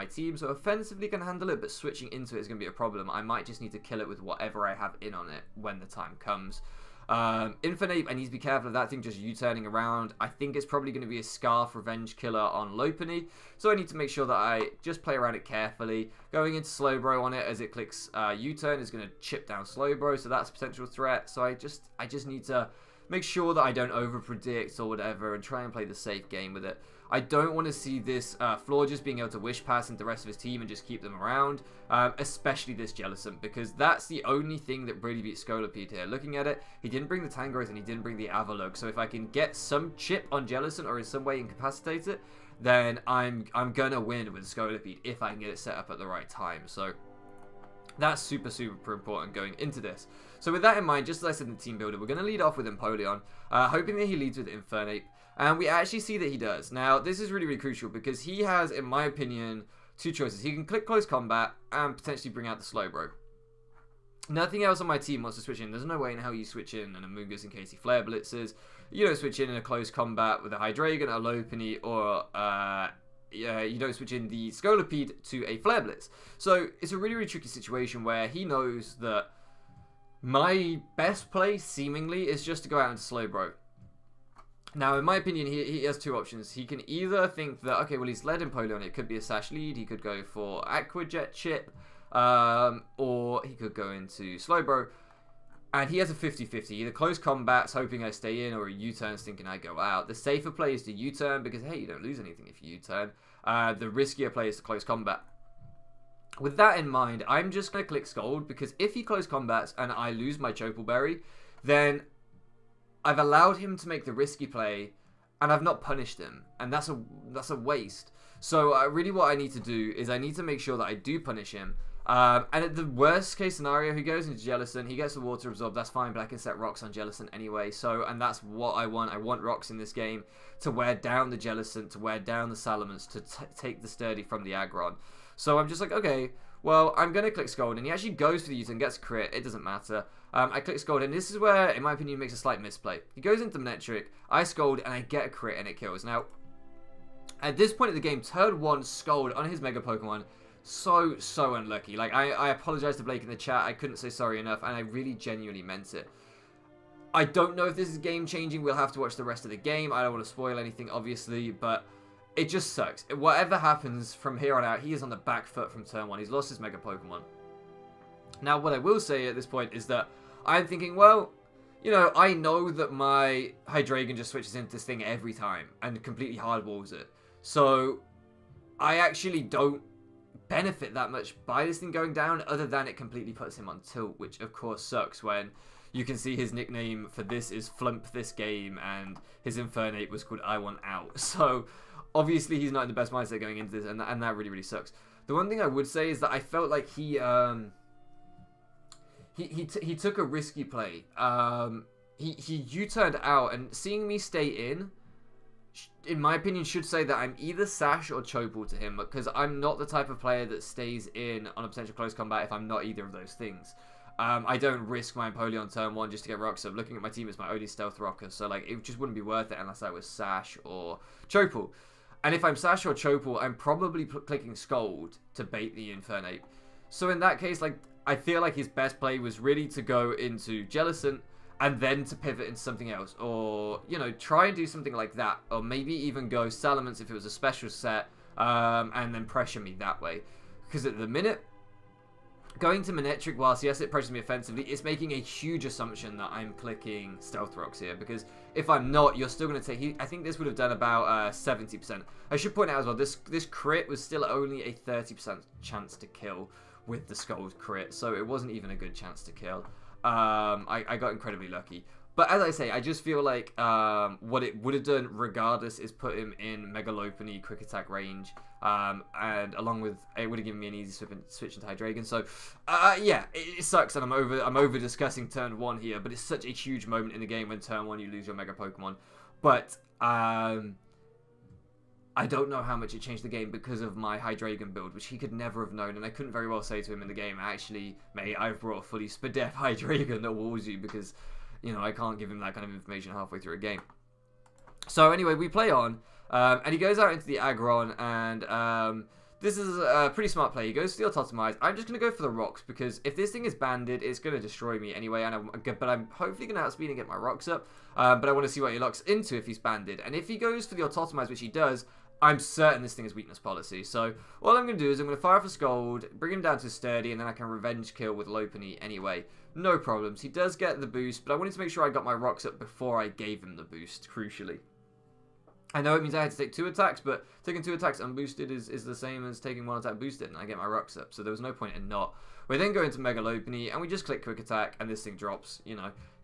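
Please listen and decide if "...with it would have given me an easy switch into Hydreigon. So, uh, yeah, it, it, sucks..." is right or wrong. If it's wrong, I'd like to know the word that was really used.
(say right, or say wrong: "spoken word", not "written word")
right.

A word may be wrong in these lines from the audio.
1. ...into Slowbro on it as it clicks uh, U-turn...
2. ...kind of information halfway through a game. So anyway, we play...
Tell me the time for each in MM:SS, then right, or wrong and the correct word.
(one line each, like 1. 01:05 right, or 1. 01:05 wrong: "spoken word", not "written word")
1. 00:16 right
2. 04:52 right.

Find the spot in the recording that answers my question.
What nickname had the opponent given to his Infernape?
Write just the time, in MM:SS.
03:10.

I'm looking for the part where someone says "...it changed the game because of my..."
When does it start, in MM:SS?
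04:42.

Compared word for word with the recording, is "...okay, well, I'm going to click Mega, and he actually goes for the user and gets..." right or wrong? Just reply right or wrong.
wrong.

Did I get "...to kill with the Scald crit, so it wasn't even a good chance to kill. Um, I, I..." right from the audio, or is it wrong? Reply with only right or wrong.
right.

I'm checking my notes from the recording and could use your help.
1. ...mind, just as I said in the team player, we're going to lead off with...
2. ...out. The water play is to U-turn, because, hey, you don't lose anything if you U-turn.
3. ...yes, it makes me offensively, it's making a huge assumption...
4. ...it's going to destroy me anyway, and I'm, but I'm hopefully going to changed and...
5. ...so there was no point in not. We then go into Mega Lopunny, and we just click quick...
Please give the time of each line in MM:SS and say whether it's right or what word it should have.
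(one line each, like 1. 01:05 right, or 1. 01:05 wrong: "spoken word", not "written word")
1. 00:50 wrong: "builder", not "player"
2. 01:39 wrong: "safer", not "water"
3. 04:03 wrong: "approaches", not "makes"
4. 05:04 wrong: "outspeed", not "changed"
5. 05:31 right.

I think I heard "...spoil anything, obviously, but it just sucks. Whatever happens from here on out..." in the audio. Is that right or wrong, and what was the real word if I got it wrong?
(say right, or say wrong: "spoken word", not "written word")
right.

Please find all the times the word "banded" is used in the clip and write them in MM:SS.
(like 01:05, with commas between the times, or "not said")
05:03, 05:09.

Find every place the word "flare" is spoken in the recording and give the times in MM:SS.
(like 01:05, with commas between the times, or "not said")
01:07, 01:15.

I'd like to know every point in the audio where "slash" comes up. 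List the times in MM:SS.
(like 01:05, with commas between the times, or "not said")
not said.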